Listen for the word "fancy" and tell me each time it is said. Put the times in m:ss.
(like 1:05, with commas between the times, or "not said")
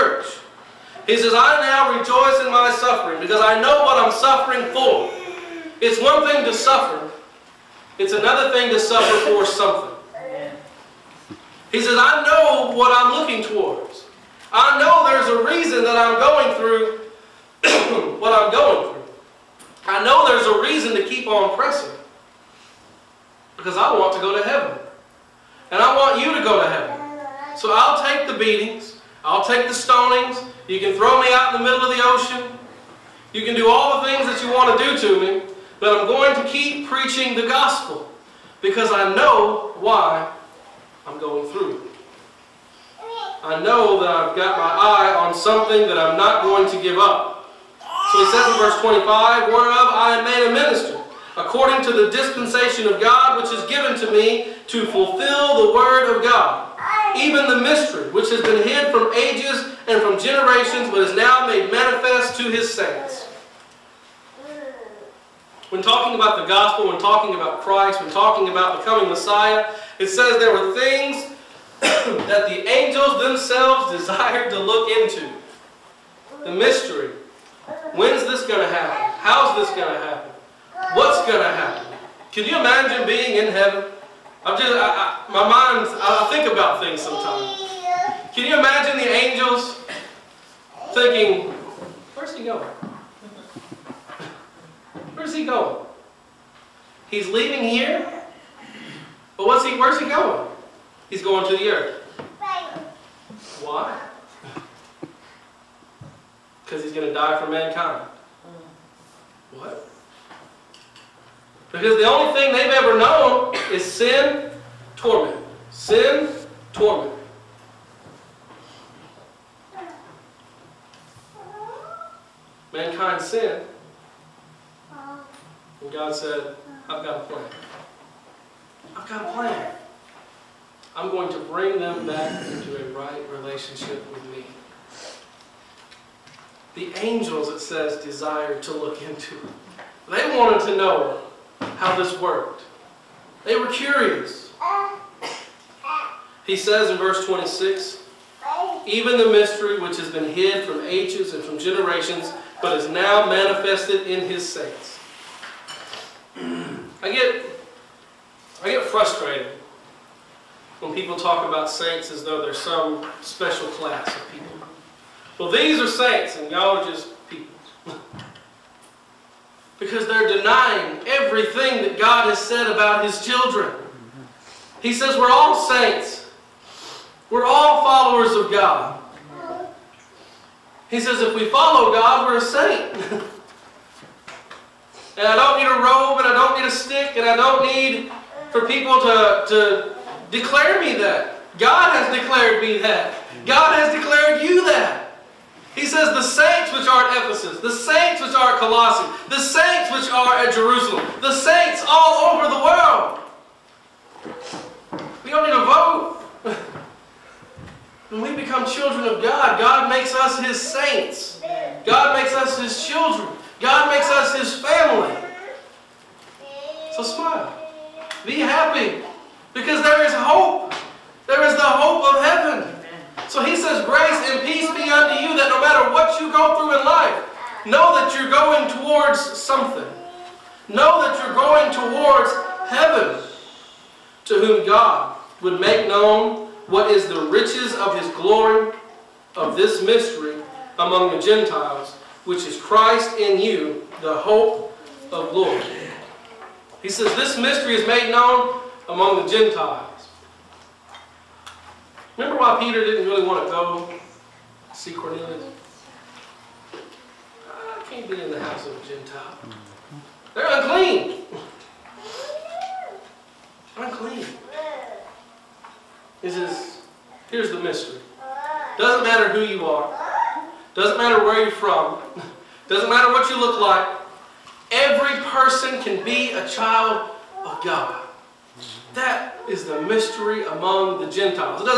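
not said.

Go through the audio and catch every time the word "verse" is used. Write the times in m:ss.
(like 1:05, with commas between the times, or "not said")
0:48, 2:26.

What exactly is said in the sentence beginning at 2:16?
The angels, it says, desired to look into They wanted to know how this worked.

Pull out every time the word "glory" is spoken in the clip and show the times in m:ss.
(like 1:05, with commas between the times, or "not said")
3:58, 4:05.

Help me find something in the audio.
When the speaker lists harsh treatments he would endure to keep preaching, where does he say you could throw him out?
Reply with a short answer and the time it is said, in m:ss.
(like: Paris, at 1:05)
the middle of the ocean, at 0:31.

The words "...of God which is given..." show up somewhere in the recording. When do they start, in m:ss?
0:52.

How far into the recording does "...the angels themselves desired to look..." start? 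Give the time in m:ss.
1:12.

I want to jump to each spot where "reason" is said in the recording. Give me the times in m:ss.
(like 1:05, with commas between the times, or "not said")
0:15, 0:20.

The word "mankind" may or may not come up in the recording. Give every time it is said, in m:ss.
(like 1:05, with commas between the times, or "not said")
1:47, 2:02.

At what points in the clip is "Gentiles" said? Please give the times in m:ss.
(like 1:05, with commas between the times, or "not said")
4:01, 4:09, 4:18, 4:41.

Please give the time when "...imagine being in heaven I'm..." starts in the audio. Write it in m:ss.
1:22.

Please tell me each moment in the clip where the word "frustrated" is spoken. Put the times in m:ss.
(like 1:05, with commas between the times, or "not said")
2:38.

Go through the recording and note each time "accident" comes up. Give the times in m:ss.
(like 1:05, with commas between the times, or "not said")
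not said.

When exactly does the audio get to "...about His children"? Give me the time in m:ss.
2:52.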